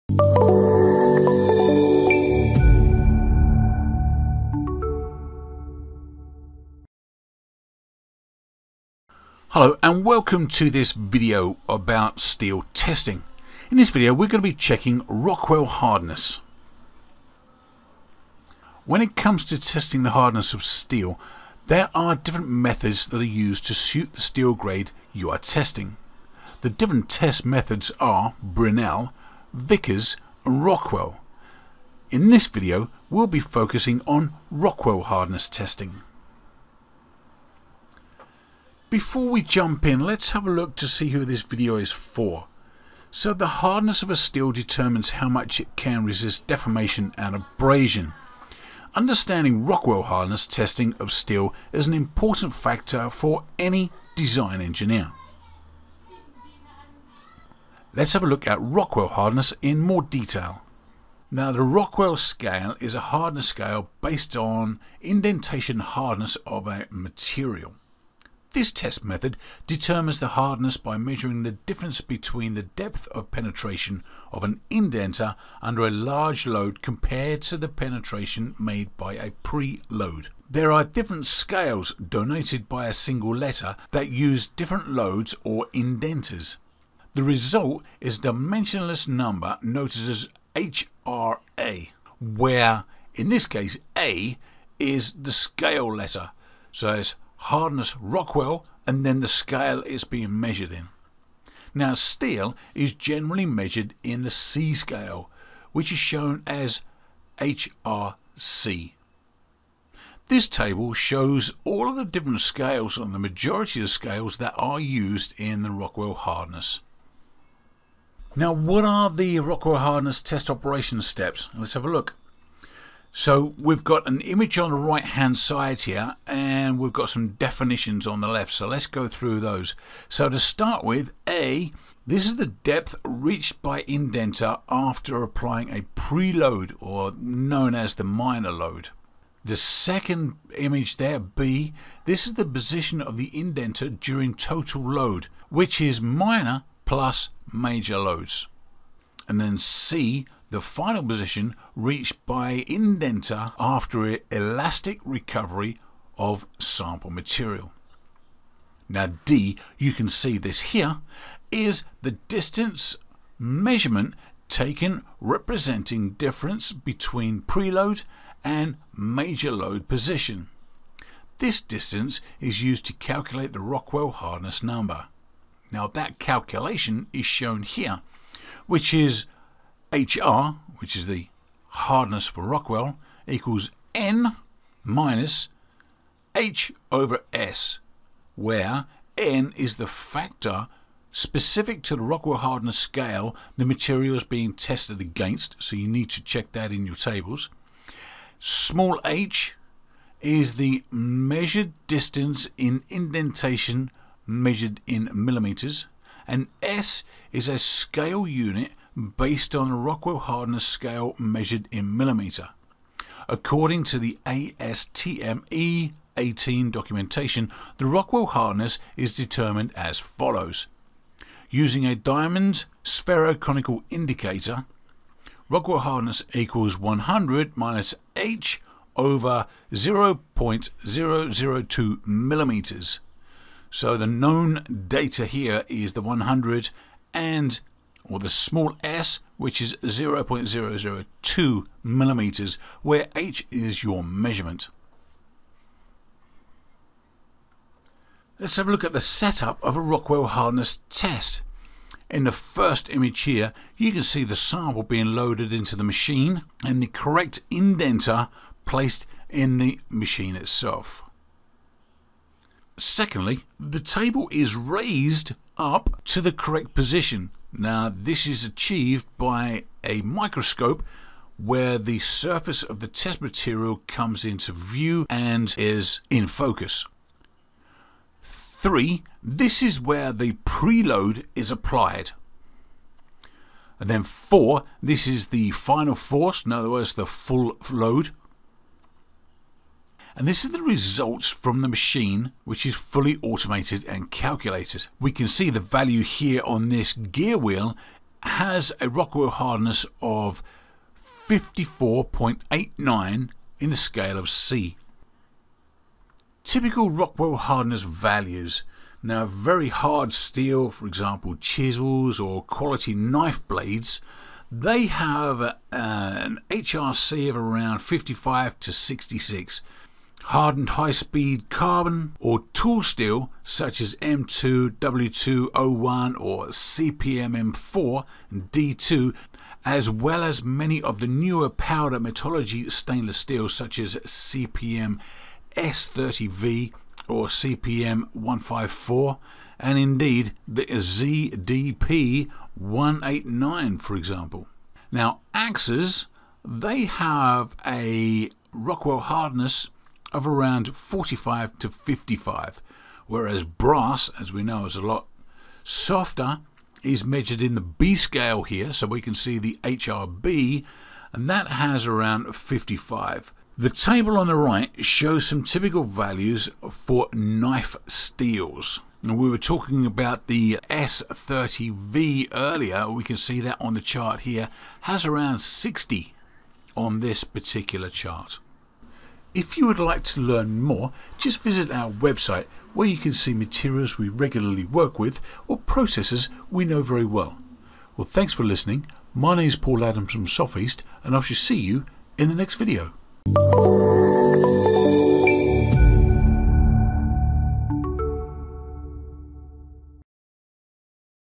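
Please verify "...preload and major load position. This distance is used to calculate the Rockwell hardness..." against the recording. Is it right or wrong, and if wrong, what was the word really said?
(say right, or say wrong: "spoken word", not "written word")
right.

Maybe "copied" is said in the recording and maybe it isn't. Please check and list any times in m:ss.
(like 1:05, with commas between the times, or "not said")
not said.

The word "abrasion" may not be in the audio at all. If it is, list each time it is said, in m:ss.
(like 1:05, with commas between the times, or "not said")
0:47.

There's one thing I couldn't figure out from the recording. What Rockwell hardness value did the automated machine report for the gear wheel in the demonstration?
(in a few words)
54.89.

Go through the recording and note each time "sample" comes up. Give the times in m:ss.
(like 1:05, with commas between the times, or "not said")
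2:36, 4:14.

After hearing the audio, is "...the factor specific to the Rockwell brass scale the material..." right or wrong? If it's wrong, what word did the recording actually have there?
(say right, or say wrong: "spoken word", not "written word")
wrong: "hardness", not "brass".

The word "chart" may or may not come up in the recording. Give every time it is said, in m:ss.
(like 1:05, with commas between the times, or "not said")
6:13, 6:17.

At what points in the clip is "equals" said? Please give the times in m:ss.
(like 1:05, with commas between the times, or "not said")
3:03, 3:46.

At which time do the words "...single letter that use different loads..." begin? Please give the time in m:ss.
1:22.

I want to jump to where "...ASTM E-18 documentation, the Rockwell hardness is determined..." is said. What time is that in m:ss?
3:34.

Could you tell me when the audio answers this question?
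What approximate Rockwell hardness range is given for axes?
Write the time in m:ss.
5:50.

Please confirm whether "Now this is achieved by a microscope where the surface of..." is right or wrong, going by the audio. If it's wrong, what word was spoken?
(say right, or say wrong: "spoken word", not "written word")
right.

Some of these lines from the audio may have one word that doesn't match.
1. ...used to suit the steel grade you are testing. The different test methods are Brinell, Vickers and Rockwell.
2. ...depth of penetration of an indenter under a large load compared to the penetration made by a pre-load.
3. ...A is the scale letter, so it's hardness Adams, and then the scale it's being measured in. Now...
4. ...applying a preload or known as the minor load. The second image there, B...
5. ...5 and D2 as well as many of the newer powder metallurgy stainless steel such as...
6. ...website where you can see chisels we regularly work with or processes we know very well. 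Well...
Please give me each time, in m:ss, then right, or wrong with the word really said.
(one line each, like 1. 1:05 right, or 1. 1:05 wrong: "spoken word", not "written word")
1. 0:23 right
2. 1:12 right
3. 1:33 wrong: "Rockwell", not "Adams"
4. 2:15 right
5. 5:27 wrong: "4", not "5"
6. 6:21 wrong: "materials", not "chisels".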